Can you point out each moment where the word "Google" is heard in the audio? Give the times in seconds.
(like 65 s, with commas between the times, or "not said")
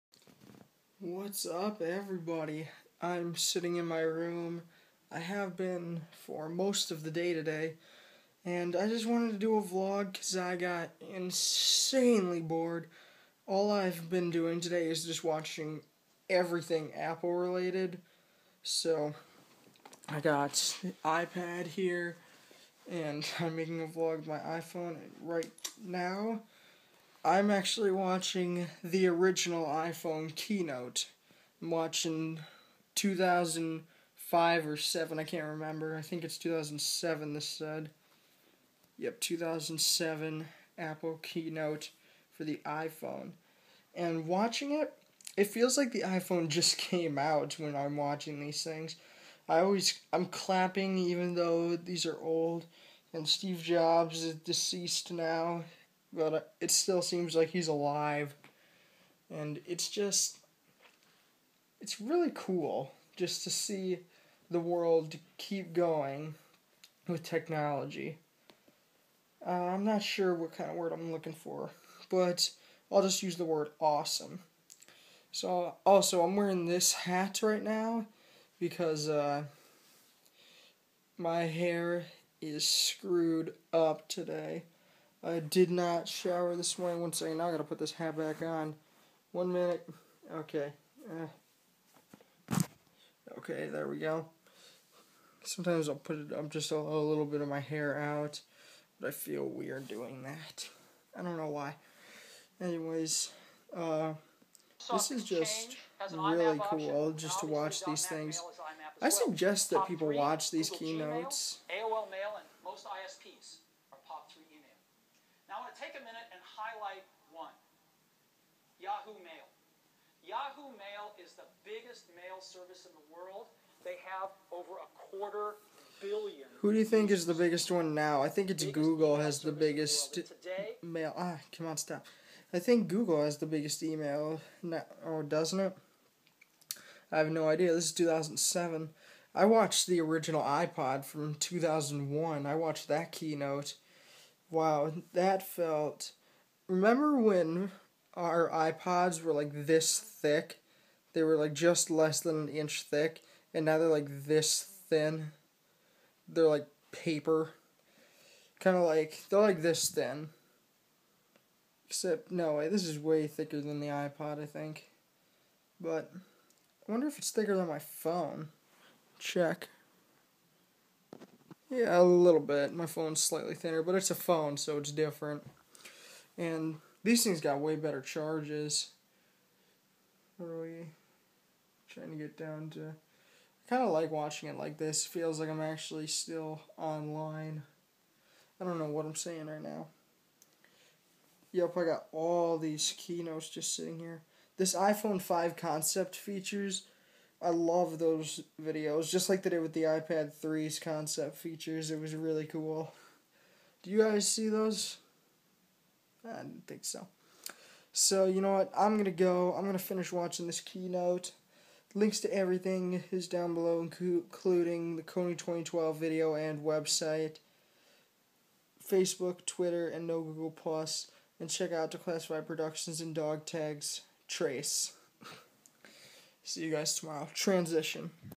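128 s, 132 s, 220 s.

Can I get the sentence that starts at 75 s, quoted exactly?
So, also, I'm wearing this hat right now because uh, my hair is screwed up today.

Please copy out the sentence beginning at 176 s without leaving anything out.
And these things got way better charges.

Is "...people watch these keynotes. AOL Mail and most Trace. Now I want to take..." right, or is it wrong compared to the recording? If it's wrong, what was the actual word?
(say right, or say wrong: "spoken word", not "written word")
wrong: "ISPs", not "Trace".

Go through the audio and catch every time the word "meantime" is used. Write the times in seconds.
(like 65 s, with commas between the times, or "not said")
not said.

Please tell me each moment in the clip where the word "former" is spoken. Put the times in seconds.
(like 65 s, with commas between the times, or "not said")
not said.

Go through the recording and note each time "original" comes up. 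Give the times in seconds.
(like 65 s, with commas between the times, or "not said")
29 s, 139 s.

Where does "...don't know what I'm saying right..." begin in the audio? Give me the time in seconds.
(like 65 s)
188 s.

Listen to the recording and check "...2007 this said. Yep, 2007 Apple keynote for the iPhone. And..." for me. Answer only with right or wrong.
right.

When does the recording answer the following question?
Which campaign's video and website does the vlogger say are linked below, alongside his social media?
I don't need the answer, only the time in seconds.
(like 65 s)
215 s.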